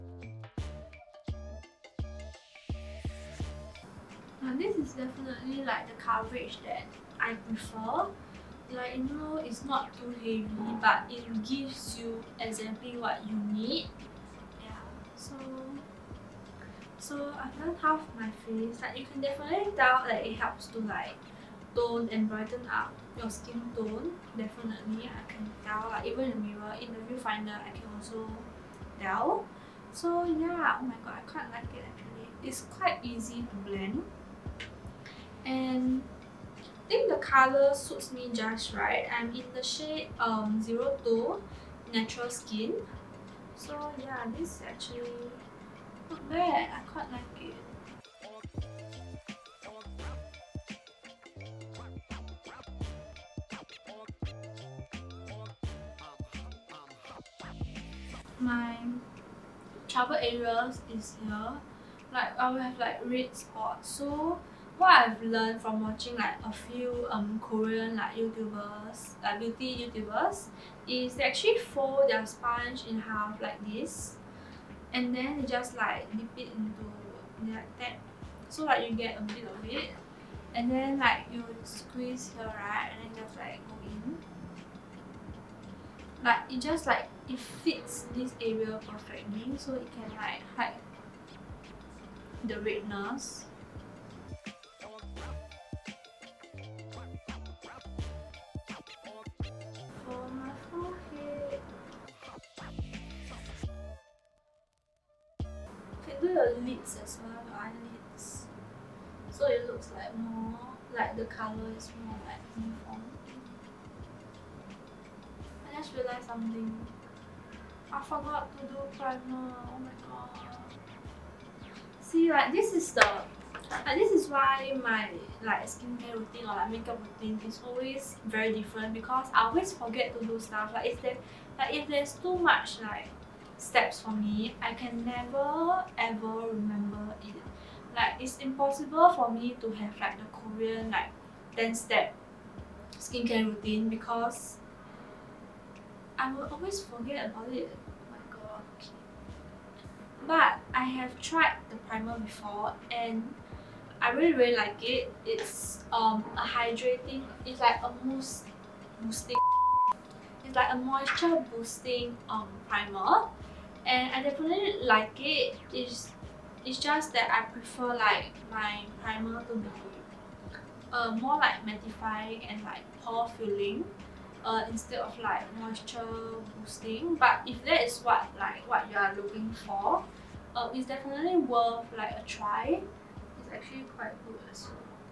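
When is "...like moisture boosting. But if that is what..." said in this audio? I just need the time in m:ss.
2:55.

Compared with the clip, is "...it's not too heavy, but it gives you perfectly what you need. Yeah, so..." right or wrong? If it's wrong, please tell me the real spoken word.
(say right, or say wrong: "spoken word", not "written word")
wrong: "exactly", not "perfectly".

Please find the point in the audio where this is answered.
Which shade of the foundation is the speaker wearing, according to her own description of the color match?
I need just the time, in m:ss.
0:40.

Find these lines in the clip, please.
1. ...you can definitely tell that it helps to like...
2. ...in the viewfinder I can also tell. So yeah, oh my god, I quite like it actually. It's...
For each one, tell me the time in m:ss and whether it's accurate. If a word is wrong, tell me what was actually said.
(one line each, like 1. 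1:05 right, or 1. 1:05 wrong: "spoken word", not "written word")
1. 0:18 right
2. 0:26 right.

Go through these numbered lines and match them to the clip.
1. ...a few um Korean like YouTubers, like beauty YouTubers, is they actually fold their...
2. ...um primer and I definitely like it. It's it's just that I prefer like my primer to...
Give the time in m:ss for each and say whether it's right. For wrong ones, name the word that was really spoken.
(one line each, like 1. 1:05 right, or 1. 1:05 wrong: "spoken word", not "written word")
1. 1:06 right
2. 2:42 right.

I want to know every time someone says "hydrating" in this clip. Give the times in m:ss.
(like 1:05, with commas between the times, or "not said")
2:36.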